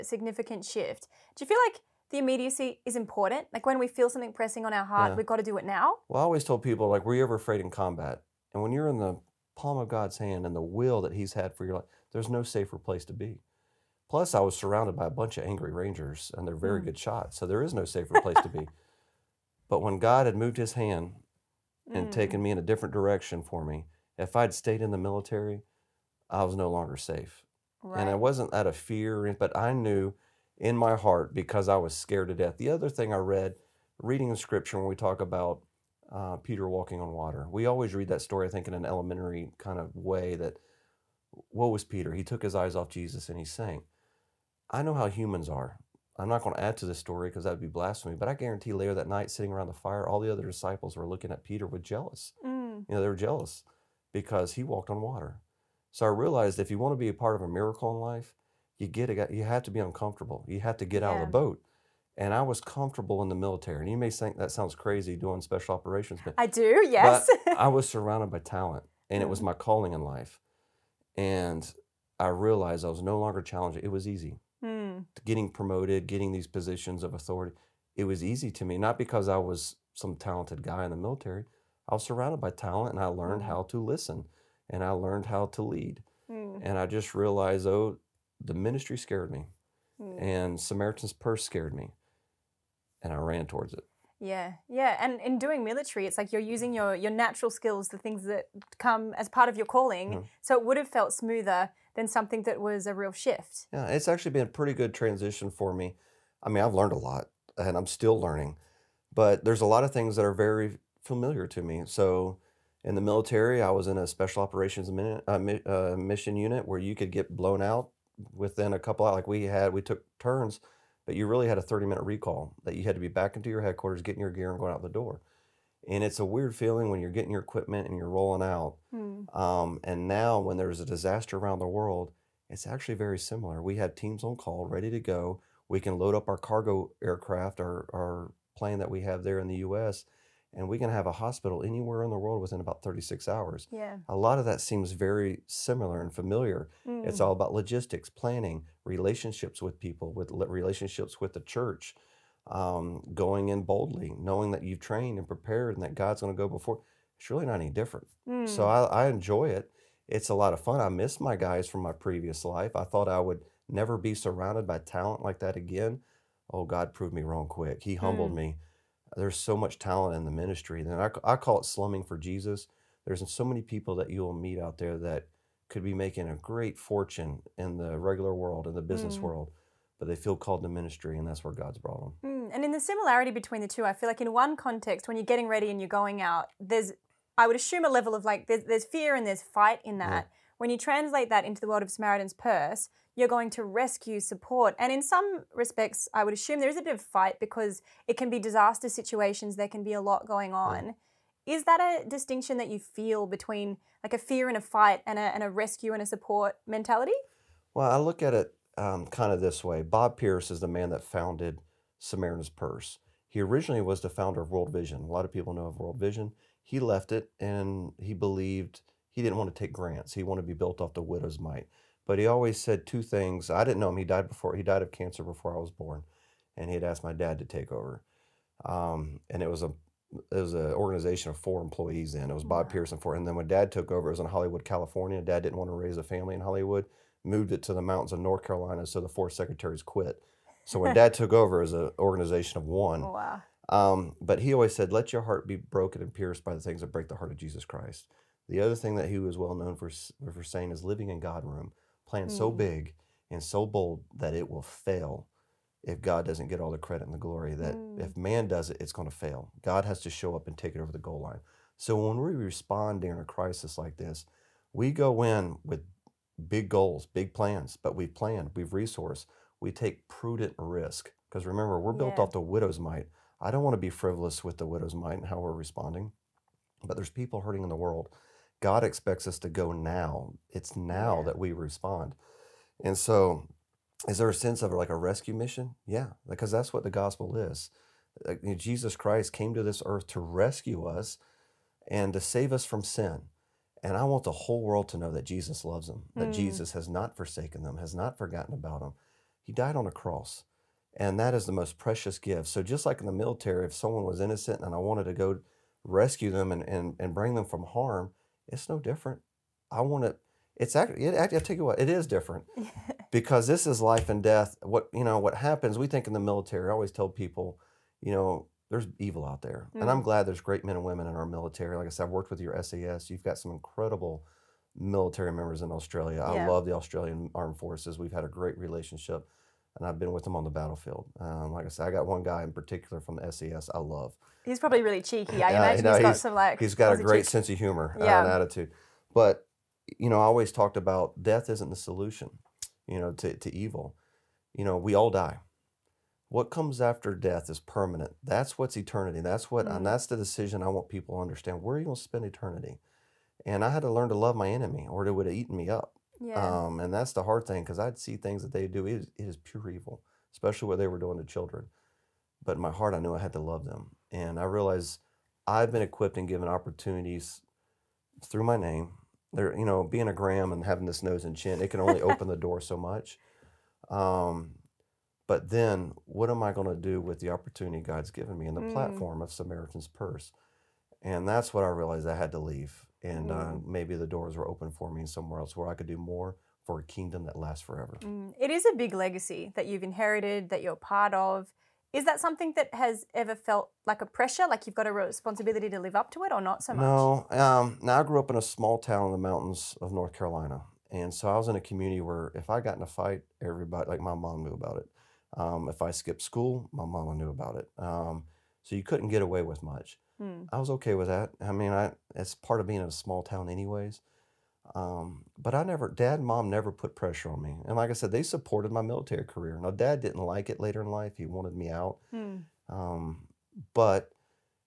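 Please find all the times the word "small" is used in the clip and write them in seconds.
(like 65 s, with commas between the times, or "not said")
398 s, 412 s.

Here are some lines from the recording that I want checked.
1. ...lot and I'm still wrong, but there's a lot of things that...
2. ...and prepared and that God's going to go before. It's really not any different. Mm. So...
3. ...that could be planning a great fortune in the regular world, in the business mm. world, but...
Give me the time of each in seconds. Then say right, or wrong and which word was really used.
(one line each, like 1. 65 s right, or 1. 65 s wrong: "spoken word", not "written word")
1. 106 s wrong: "learning", not "wrong"
2. 155 s right
3. 174 s wrong: "making", not "planning".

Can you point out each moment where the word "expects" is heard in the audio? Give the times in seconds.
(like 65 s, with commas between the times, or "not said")
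278 s.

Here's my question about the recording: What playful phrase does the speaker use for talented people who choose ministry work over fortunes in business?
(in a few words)
Slumming for Jesus.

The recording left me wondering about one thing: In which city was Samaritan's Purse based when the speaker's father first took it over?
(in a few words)
Hollywood, California.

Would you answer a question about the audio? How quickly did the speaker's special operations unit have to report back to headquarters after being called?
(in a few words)
30 minutes.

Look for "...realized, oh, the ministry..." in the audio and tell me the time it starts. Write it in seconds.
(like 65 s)
87 s.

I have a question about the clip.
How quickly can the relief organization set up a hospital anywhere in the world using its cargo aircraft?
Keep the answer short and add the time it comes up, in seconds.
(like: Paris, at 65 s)
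About 36 hours, at 142 s.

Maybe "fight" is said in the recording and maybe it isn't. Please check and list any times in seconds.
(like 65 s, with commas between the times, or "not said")
189 s, 197 s, 204 s, 402 s.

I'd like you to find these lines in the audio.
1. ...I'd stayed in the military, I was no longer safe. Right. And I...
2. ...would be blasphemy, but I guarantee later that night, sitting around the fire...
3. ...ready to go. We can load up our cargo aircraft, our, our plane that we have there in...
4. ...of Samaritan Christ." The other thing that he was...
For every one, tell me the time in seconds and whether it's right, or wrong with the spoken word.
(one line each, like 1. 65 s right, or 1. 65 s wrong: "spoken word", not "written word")
1. 24 s right
2. 47 s right
3. 134 s right
4. 247 s wrong: "Jesus", not "Samaritan".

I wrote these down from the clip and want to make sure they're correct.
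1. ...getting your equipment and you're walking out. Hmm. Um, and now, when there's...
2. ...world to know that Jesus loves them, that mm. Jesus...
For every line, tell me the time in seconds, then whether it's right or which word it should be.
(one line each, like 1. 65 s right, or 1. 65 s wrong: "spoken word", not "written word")
1. 127 s wrong: "rolling", not "walking"
2. 294 s right.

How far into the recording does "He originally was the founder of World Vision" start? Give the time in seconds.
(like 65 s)
213 s.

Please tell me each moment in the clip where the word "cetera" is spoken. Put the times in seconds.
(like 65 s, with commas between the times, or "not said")
not said.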